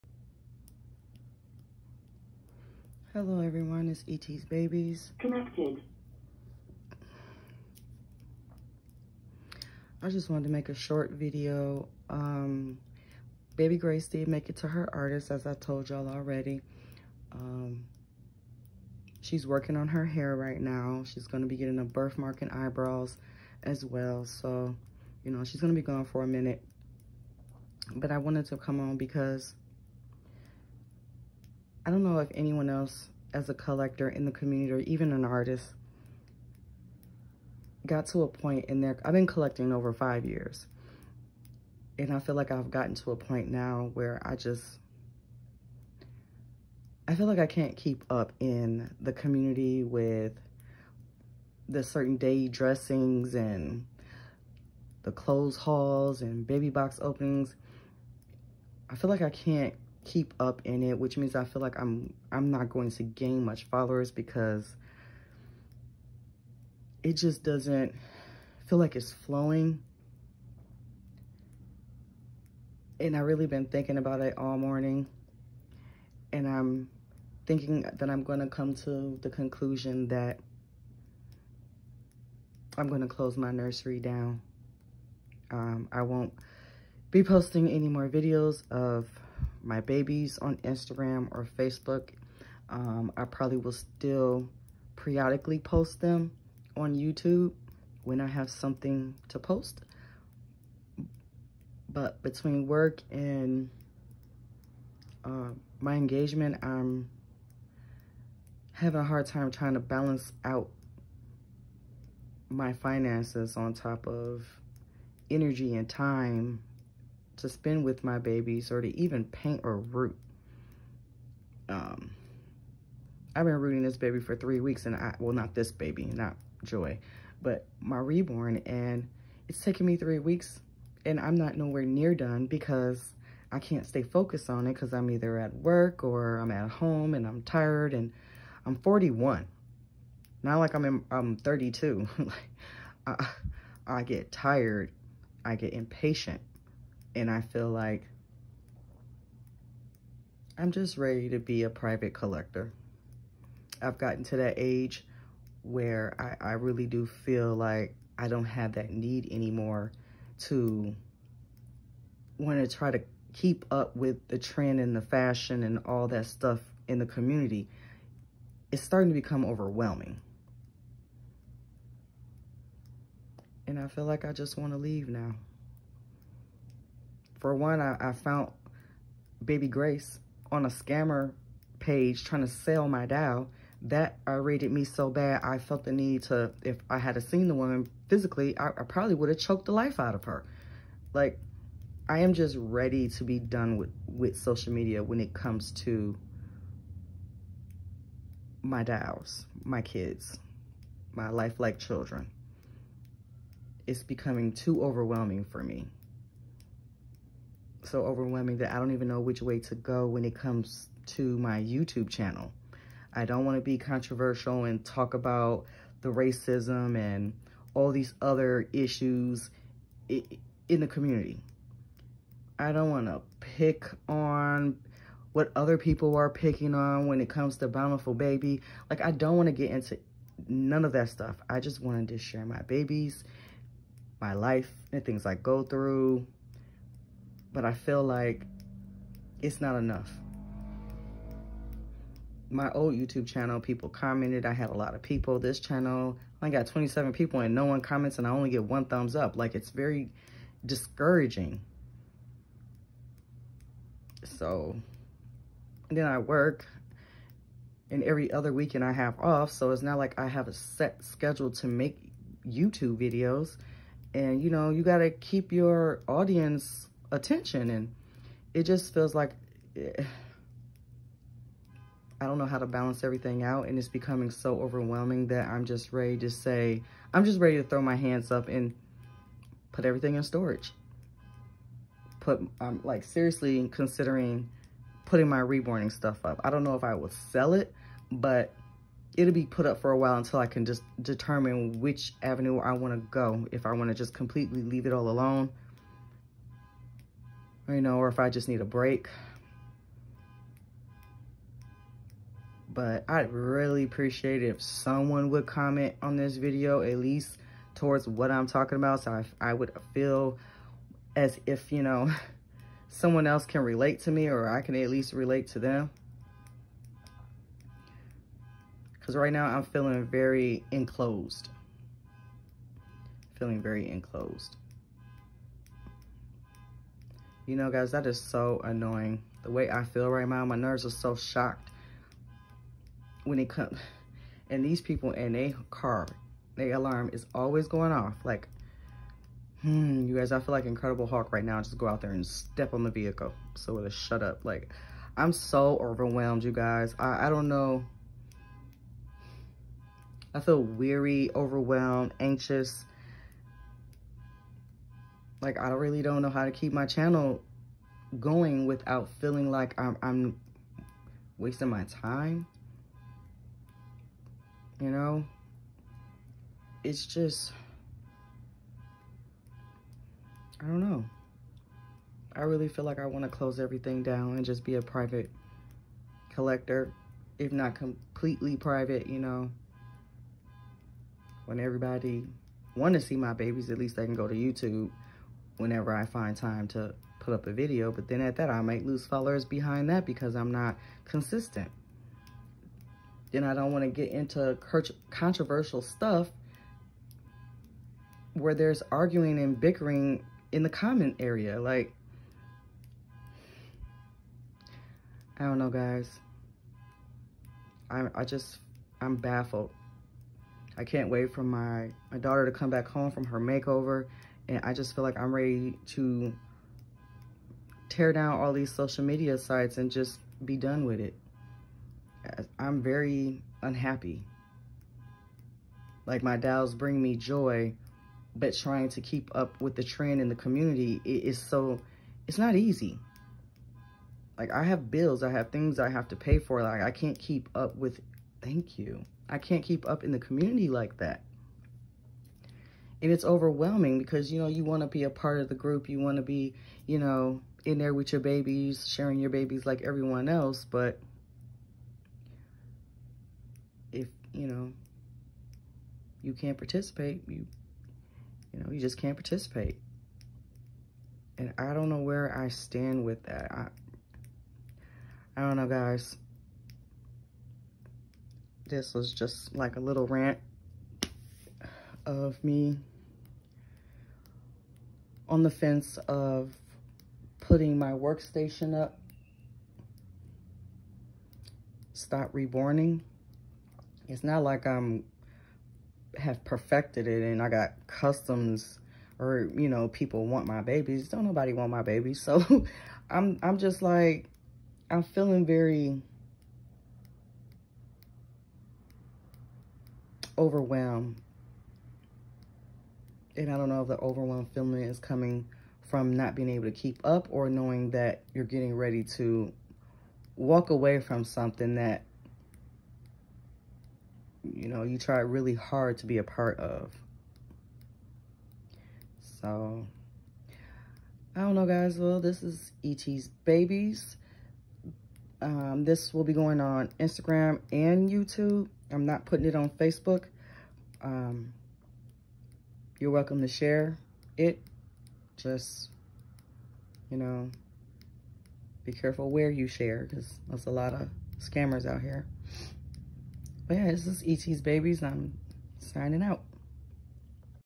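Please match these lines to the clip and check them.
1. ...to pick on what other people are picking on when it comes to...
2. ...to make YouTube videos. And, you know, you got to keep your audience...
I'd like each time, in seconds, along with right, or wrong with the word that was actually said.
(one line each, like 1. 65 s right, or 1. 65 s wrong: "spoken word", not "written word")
1. 223 s right
2. 261 s right.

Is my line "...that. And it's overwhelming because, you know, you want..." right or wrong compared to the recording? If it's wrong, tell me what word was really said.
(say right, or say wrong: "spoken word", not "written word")
right.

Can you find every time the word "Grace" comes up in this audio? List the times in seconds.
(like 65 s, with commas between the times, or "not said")
13 s, 179 s.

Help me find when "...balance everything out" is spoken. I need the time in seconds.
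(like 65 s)
272 s.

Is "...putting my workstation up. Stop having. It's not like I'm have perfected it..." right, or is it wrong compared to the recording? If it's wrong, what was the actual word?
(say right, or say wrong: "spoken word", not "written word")
wrong: "reborning", not "having".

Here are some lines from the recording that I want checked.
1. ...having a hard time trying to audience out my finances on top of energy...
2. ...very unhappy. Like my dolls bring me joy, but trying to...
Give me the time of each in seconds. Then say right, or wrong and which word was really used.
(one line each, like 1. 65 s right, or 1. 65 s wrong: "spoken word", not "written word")
1. 108 s wrong: "balance", not "audience"
2. 422 s right.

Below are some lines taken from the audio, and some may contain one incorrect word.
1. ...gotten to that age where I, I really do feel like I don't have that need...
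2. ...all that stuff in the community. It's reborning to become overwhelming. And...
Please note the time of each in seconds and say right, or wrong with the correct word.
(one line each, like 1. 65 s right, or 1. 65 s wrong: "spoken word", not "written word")
1. 153 s right
2. 165 s wrong: "starting", not "reborning".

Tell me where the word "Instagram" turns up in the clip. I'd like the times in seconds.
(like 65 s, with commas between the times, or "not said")
90 s, 526 s.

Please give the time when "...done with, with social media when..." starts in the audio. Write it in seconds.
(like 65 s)
193 s.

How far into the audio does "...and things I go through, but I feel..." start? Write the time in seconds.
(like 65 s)
234 s.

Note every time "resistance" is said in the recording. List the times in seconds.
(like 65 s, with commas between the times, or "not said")
not said.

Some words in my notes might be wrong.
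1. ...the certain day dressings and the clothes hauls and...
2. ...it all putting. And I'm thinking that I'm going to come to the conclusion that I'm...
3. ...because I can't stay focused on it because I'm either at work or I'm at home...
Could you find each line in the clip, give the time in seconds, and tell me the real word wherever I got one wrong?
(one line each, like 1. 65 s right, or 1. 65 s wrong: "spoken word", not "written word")
1. 51 s right
2. 74 s wrong: "morning", not "putting"
3. 132 s right.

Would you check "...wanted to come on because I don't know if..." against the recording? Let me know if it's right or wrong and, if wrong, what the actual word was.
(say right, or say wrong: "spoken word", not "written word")
right.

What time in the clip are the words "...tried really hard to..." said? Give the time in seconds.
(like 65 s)
514 s.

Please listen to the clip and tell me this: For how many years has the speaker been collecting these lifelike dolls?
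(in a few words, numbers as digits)
over 5 years.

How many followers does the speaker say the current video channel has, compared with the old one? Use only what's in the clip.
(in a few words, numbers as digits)
27.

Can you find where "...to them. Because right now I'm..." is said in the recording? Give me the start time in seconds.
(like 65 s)
315 s.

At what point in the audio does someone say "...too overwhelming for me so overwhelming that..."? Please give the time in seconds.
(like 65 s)
204 s.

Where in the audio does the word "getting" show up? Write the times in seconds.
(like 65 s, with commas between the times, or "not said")
21 s, 508 s.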